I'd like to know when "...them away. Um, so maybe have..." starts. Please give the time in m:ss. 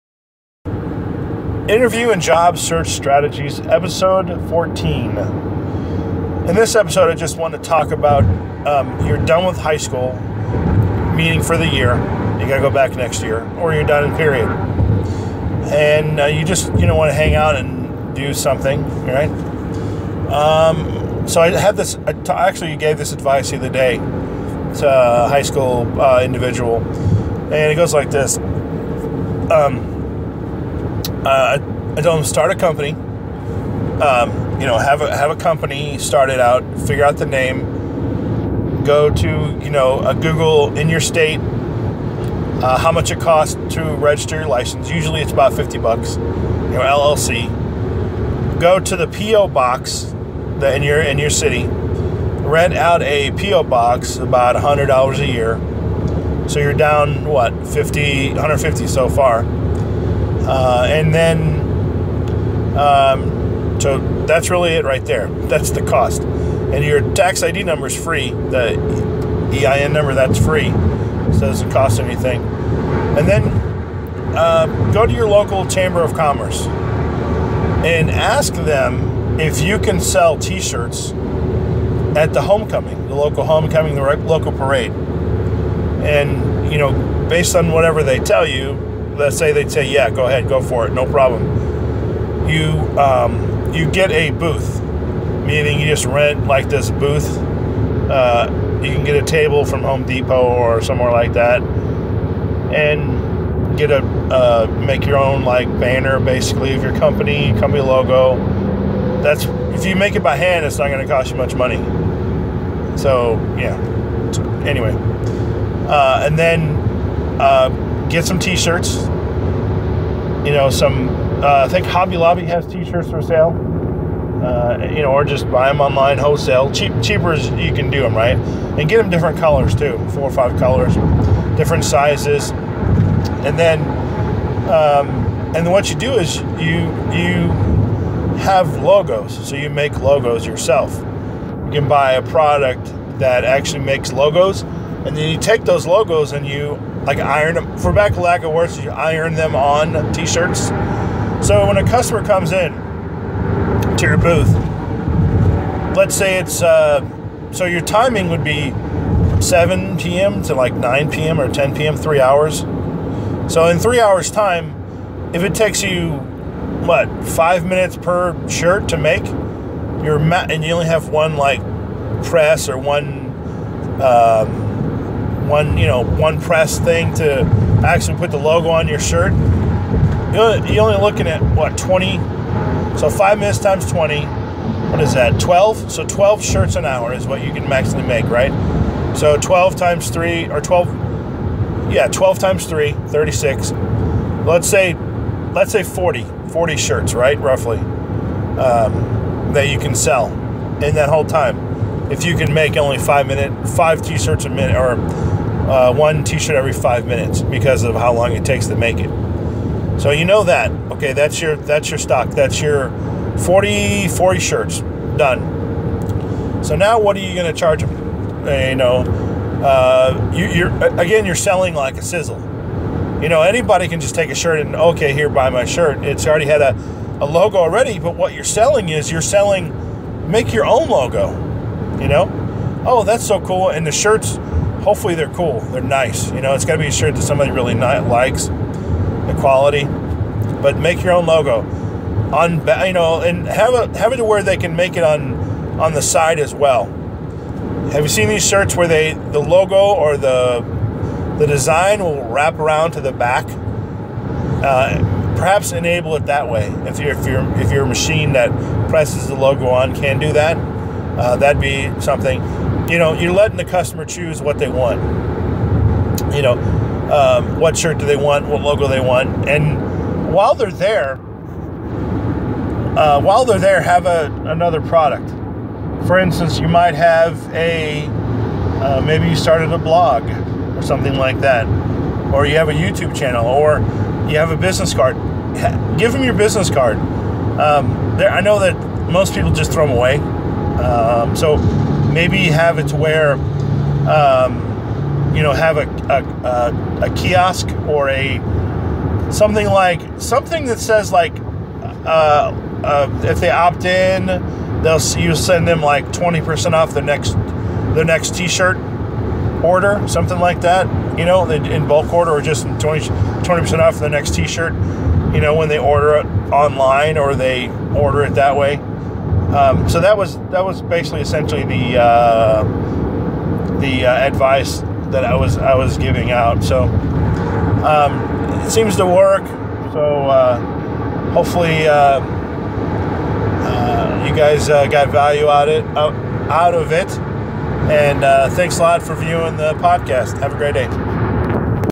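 4:49.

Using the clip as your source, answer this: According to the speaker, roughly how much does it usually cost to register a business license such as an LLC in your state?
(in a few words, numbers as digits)
$50.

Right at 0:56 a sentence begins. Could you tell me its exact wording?
So you're down what 50, 150 so far uh, and then, um, so that's really it right there.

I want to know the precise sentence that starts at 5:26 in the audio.
So um, it seems to work.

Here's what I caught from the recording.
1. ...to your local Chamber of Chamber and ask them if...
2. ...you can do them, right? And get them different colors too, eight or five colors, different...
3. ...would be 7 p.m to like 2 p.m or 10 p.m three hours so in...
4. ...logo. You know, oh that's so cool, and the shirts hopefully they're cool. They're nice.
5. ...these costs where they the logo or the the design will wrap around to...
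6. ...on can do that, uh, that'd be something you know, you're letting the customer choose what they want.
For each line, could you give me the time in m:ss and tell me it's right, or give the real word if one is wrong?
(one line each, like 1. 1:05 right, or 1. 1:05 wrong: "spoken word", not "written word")
1. 1:15 wrong: "Commerce", not "Chamber"
2. 2:07 wrong: "four", not "eight"
3. 2:38 wrong: "9", not "2"
4. 3:50 right
5. 4:08 wrong: "shirts", not "costs"
6. 4:19 right.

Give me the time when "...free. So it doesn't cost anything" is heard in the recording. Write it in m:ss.
1:10.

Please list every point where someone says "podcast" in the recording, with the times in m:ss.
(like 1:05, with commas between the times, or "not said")
5:39.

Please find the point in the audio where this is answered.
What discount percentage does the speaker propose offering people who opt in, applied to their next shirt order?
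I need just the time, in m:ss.
5:06.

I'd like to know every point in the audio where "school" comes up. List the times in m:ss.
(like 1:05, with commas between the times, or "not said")
0:09, 0:25.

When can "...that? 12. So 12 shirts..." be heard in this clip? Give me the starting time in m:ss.
3:05.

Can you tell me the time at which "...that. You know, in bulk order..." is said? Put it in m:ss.
5:10.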